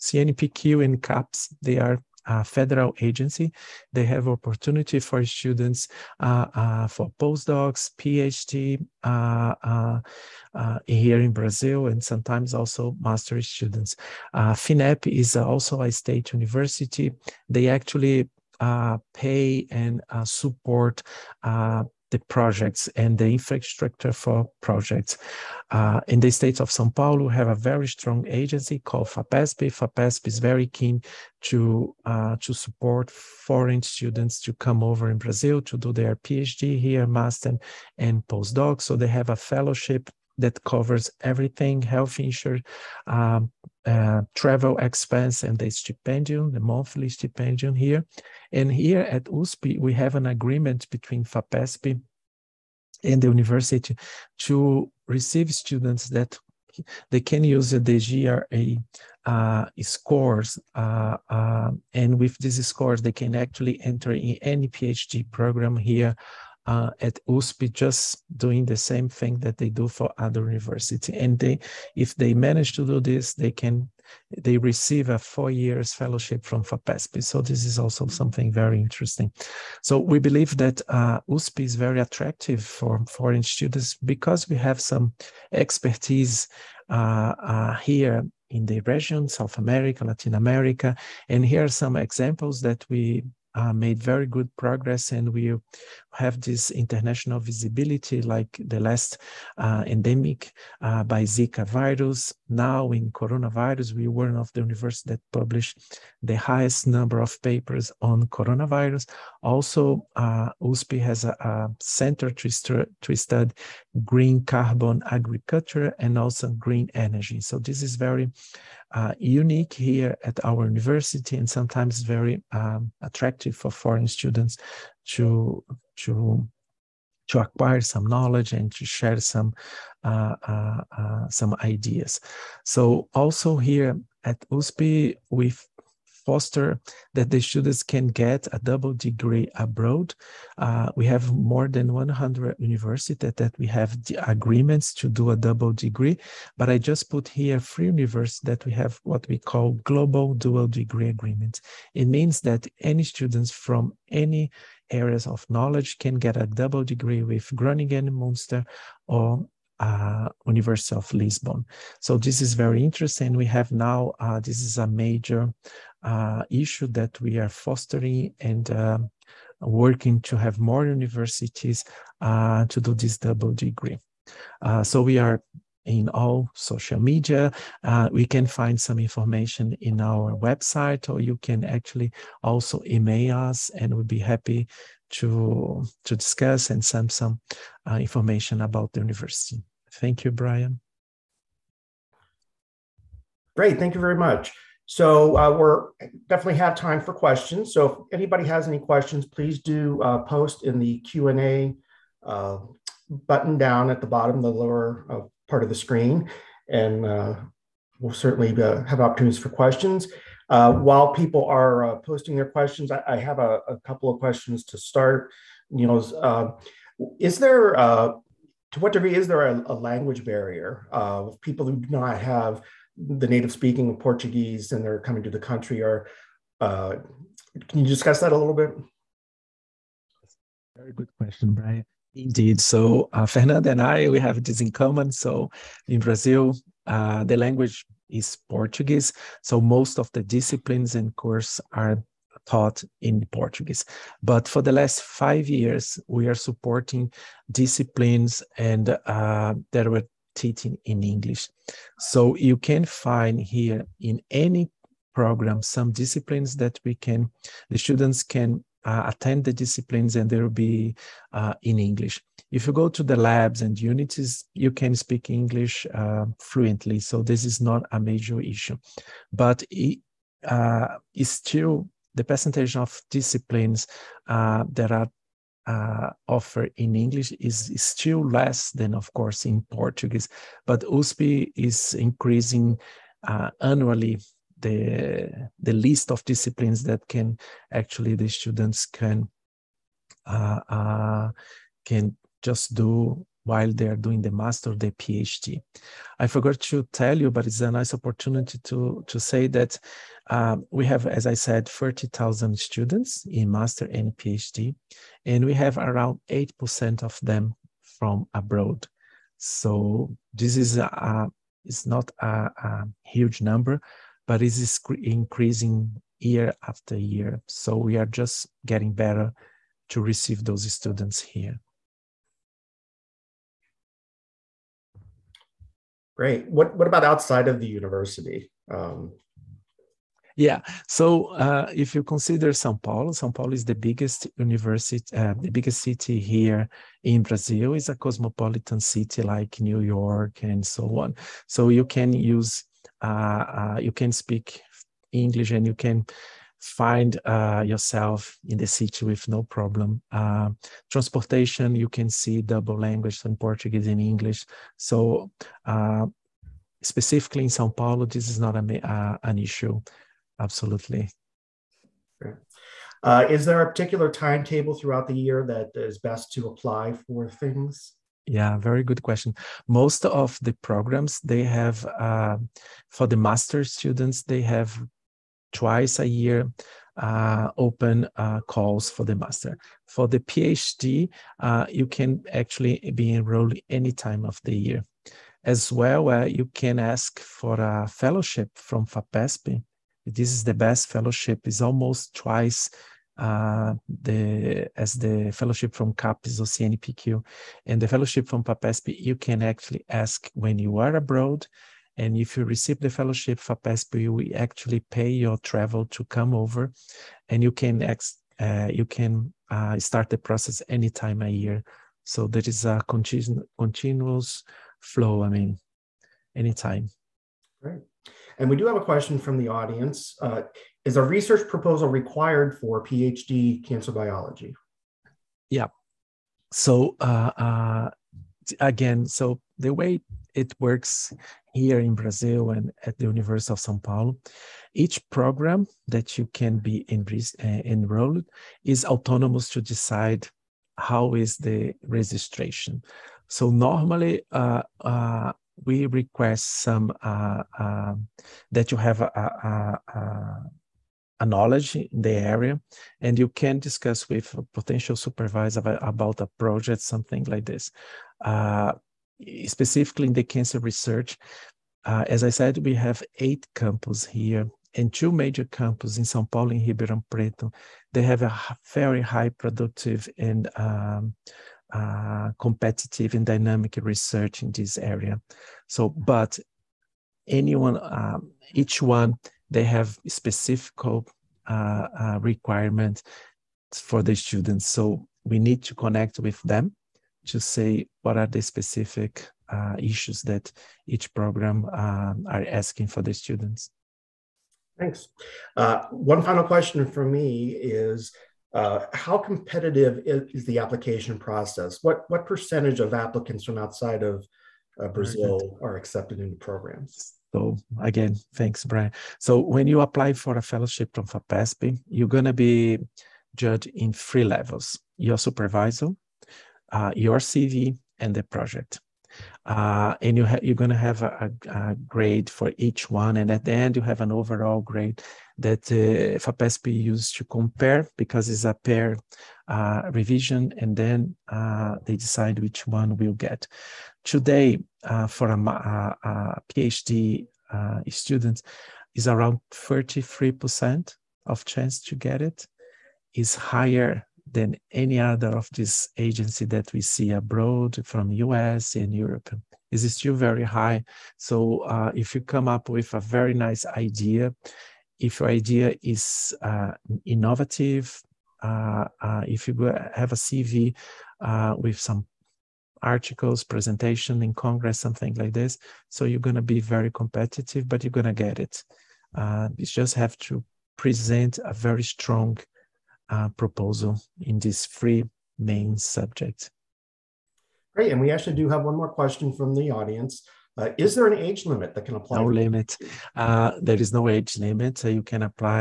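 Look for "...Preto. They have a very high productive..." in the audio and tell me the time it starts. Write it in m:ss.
7:47.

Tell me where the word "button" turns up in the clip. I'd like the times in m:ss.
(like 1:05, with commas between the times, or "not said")
3:23.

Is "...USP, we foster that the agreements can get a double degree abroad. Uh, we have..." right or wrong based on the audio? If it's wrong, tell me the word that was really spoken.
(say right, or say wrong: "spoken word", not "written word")
wrong: "students", not "agreements".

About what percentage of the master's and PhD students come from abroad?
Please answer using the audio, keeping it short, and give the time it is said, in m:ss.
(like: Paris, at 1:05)
8%, at 5:06.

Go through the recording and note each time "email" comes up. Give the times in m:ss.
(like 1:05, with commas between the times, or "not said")
3:02.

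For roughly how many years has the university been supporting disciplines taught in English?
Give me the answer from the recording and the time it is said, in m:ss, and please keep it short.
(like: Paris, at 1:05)
5, at 4:05.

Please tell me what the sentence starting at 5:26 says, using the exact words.
What what about outside of the university?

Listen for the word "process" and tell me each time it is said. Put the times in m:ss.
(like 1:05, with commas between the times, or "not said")
6:50, 8:21.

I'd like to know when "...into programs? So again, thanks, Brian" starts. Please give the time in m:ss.
8:26.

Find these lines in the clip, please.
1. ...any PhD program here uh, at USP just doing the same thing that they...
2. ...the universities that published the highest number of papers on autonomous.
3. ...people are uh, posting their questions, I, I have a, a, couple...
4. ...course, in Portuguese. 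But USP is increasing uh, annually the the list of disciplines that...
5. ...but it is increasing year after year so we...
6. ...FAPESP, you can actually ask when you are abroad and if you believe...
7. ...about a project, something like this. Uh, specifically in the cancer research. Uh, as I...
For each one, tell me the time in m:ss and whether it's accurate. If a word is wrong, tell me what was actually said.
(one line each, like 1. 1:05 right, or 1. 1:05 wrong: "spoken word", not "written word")
1. 1:04 right
2. 1:44 wrong: "coronavirus", not "autonomous"
3. 3:31 right
4. 4:39 right
5. 5:14 right
6. 6:38 wrong: "receive", not "believe"
7. 7:35 right.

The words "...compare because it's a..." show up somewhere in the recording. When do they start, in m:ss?
8:47.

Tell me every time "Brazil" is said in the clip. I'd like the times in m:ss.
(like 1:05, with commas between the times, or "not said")
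0:11, 0:35, 3:56, 5:37, 7:11, 8:24.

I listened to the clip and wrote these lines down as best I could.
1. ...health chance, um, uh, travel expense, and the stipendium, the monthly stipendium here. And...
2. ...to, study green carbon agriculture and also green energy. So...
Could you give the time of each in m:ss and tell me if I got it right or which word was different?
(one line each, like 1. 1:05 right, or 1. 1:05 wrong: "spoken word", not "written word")
1. 0:41 wrong: "insurance", not "chance"
2. 1:53 right.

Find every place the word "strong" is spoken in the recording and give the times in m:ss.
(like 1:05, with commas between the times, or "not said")
0:27, 9:31.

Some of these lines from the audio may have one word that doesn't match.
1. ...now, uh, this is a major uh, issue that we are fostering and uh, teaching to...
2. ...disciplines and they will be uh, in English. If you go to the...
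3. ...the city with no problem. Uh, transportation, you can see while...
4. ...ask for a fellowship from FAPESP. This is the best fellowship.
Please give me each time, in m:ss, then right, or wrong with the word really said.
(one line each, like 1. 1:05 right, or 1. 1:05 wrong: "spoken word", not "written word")
1. 2:43 wrong: "working", not "teaching"
2. 4:19 right
3. 5:48 wrong: "double", not "while"
4. 6:26 right.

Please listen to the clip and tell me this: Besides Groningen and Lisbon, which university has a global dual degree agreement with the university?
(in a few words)
Munster.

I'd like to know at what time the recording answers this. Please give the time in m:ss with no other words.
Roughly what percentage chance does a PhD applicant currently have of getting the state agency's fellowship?
8:59.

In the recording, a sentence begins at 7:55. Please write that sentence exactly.
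So, but anyone, um, each one, they have specific uh, uh requirement for the students.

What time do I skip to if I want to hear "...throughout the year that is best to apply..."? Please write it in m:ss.
6:04.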